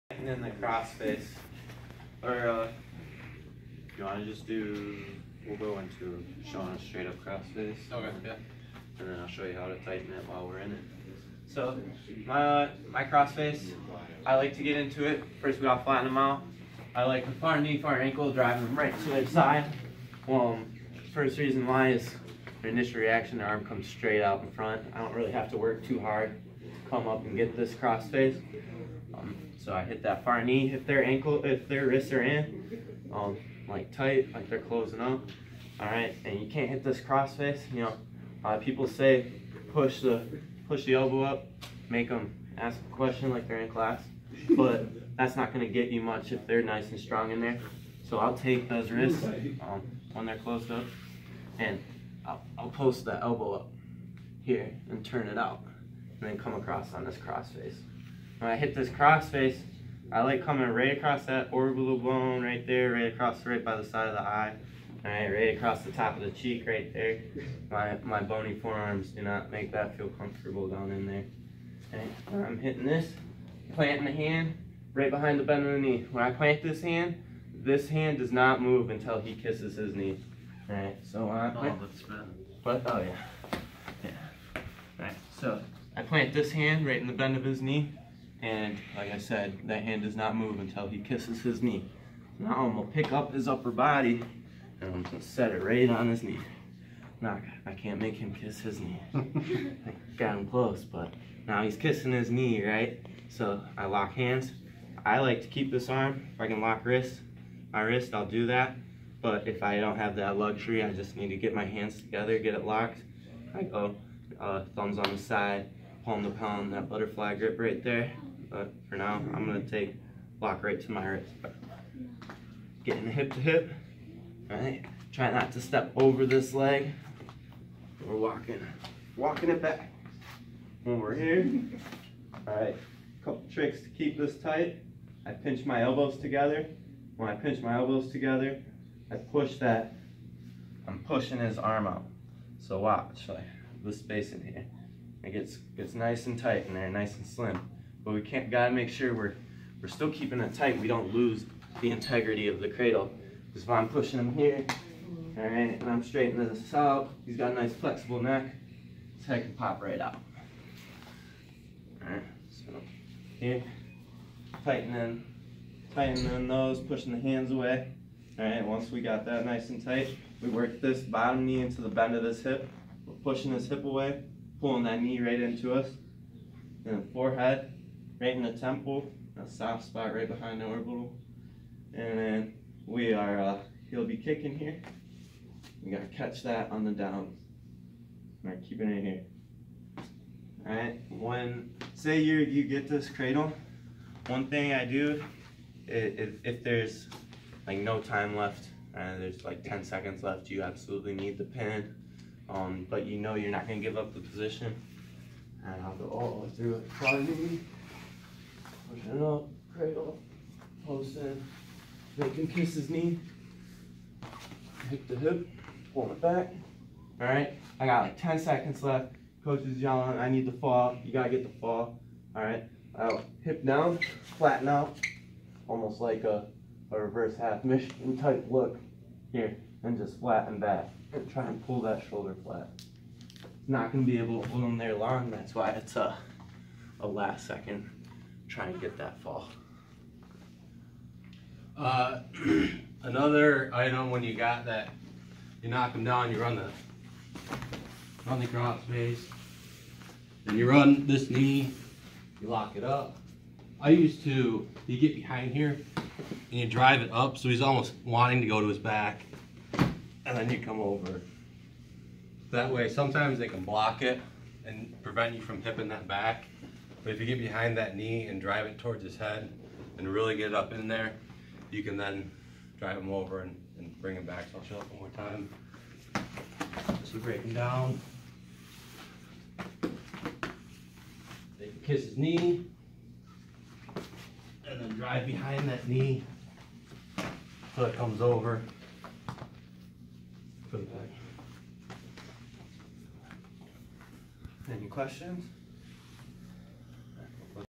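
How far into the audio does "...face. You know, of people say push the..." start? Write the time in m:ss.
0:37.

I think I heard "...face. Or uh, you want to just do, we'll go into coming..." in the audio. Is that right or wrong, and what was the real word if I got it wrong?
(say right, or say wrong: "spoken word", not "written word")
wrong: "showing", not "coming".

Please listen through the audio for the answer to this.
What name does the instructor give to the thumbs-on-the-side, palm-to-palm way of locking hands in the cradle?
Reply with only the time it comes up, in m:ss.
1:56.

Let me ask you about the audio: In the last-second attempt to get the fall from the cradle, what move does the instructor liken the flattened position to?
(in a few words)
reverse half Michigan.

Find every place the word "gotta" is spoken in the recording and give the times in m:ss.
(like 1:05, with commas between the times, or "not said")
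2:28, 3:05, 3:41.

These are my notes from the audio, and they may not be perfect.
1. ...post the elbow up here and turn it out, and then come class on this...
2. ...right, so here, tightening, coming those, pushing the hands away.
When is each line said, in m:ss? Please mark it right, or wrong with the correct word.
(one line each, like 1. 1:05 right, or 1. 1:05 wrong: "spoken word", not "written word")
1. 0:52 wrong: "across", not "class"
2. 2:42 wrong: "tightening", not "coming".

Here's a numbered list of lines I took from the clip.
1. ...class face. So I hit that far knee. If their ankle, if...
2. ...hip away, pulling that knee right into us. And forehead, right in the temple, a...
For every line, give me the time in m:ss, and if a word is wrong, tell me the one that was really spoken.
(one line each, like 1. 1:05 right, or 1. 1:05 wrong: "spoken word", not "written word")
1. 0:27 wrong: "cross", not "class"
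2. 2:53 right.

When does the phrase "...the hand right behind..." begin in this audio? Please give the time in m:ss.
1:14.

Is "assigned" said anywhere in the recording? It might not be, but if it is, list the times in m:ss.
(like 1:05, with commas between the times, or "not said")
not said.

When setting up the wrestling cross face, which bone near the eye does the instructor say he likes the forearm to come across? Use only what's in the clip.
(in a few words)
orbital bone.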